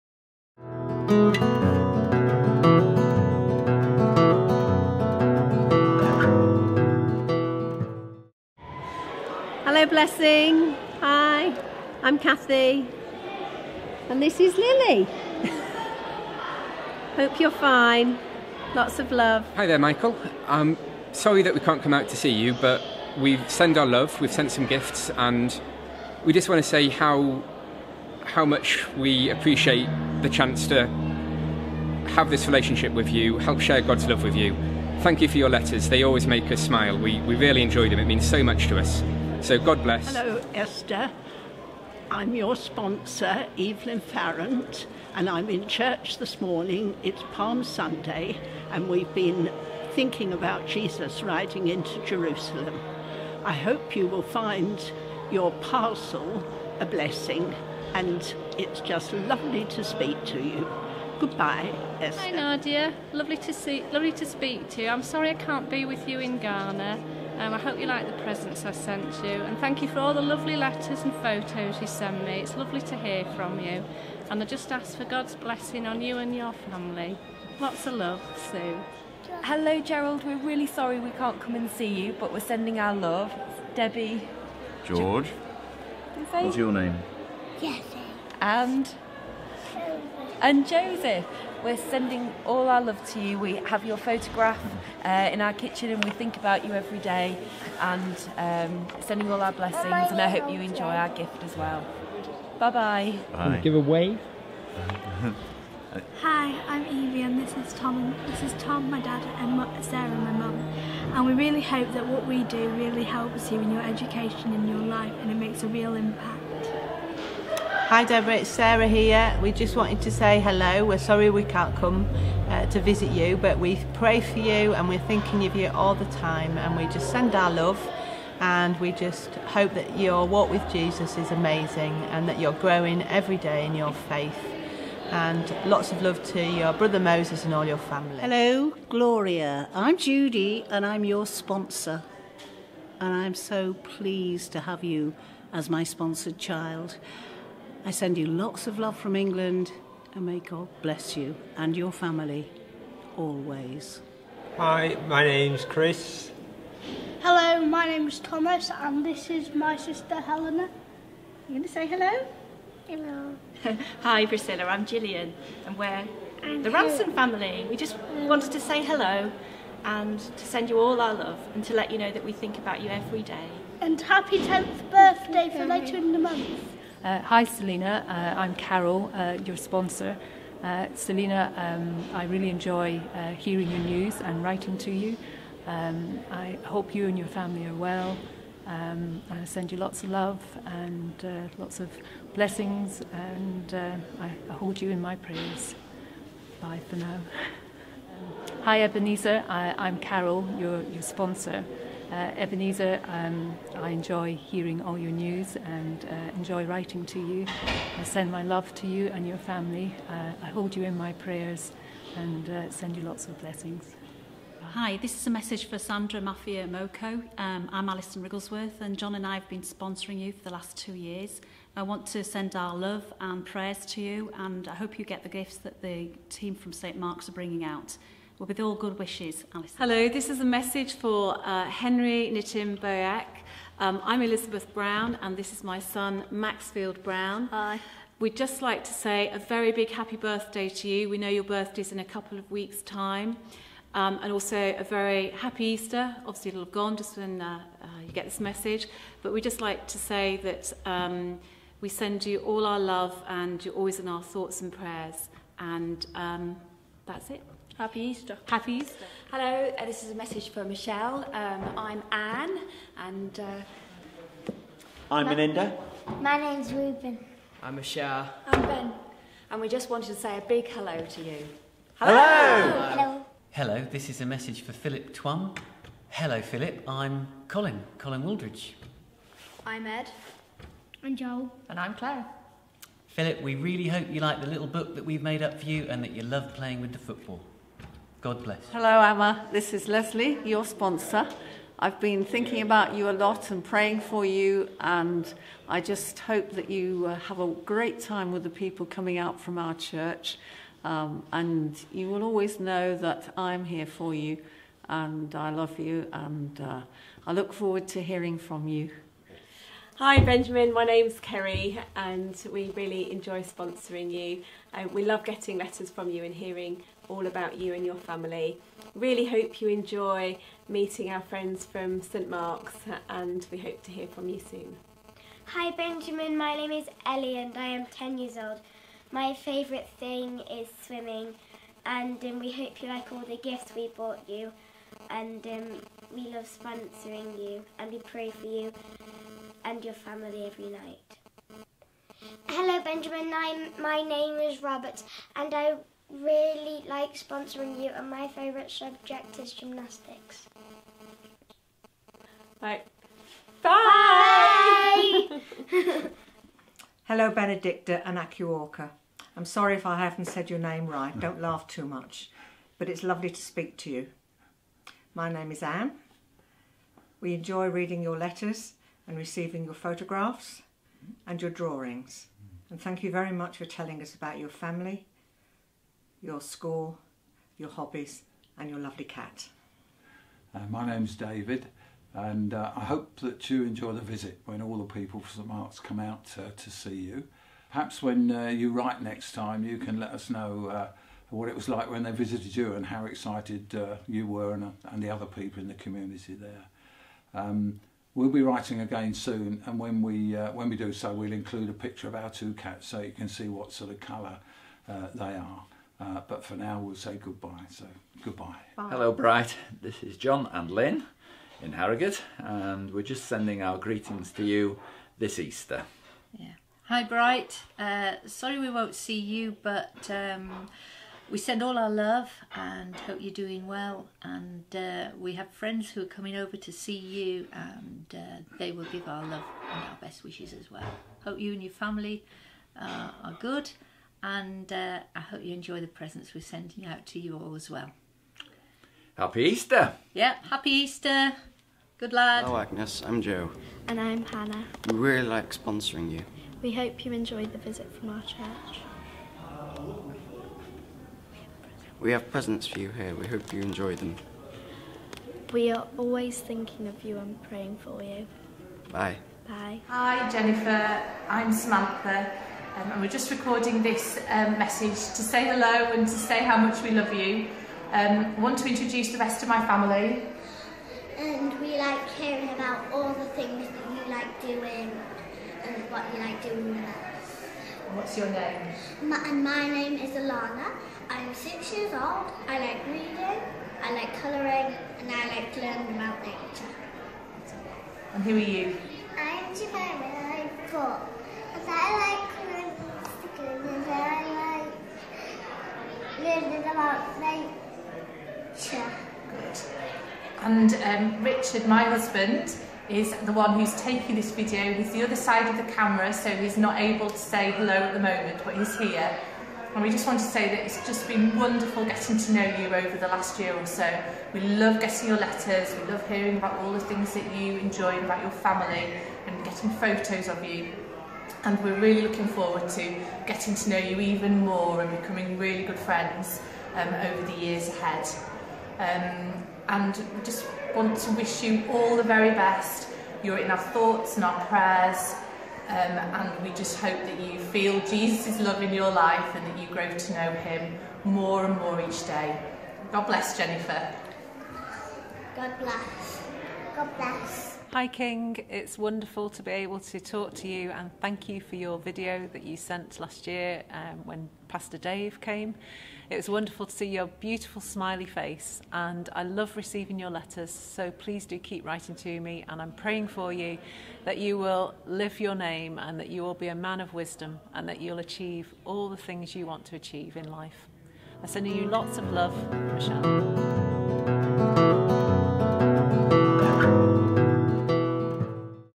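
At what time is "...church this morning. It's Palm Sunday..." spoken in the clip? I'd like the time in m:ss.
0:45.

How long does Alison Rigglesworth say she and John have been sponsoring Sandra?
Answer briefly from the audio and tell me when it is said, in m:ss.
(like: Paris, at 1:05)
2 years, at 3:40.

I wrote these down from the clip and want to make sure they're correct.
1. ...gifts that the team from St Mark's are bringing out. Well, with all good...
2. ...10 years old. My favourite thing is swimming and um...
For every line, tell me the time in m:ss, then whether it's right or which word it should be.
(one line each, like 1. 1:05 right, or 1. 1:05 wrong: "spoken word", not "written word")
1. 3:45 right
2. 5:27 right.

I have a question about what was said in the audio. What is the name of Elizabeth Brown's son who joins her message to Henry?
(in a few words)
Maxfield.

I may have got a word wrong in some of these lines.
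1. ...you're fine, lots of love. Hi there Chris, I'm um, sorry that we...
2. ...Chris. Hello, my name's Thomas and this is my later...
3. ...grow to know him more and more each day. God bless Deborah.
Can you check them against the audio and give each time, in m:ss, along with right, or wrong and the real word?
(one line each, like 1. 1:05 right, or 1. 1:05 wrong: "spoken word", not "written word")
1. 0:17 wrong: "Michael", not "Chris"
2. 2:35 wrong: "sister", not "later"
3. 8:59 wrong: "Jennifer", not "Deborah".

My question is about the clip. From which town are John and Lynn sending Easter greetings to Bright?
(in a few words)
Harrogate.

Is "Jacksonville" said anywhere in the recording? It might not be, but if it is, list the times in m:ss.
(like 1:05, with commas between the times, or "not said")
not said.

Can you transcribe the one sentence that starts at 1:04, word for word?
I'm sorry I can't be with you in Ghana.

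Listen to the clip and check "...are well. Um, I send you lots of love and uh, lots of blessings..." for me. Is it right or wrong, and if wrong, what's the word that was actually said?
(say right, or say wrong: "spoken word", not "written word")
right.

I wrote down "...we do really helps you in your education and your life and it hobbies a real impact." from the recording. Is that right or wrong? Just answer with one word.
wrong.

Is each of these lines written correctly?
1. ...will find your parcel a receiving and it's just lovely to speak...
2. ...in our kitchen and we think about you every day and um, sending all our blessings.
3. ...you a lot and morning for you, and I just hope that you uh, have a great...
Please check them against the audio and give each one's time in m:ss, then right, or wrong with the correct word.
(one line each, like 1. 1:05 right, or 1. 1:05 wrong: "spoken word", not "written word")
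1. 0:54 wrong: "blessing", not "receiving"
2. 1:35 right
3. 4:52 wrong: "praying", not "morning".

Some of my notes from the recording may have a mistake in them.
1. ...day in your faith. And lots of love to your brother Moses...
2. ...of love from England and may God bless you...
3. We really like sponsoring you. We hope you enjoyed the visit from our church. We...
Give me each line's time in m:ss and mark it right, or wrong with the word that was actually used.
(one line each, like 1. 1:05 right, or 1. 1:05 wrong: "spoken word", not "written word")
1. 2:13 right
2. 2:28 right
3. 7:24 right.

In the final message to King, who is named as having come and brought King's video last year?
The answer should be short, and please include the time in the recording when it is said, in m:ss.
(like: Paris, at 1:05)
Pastor Dave, at 9:14.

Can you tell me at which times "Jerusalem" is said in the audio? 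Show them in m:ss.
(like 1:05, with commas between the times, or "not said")
0:52.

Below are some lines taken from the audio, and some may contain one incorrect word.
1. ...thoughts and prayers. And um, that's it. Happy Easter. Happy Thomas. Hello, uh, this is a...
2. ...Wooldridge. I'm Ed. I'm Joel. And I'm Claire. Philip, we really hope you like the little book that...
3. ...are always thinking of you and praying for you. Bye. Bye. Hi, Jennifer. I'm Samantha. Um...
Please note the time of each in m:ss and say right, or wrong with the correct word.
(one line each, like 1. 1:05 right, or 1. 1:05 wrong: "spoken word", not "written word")
1. 4:14 wrong: "Easter", not "Thomas"
2. 4:38 right
3. 7:35 right.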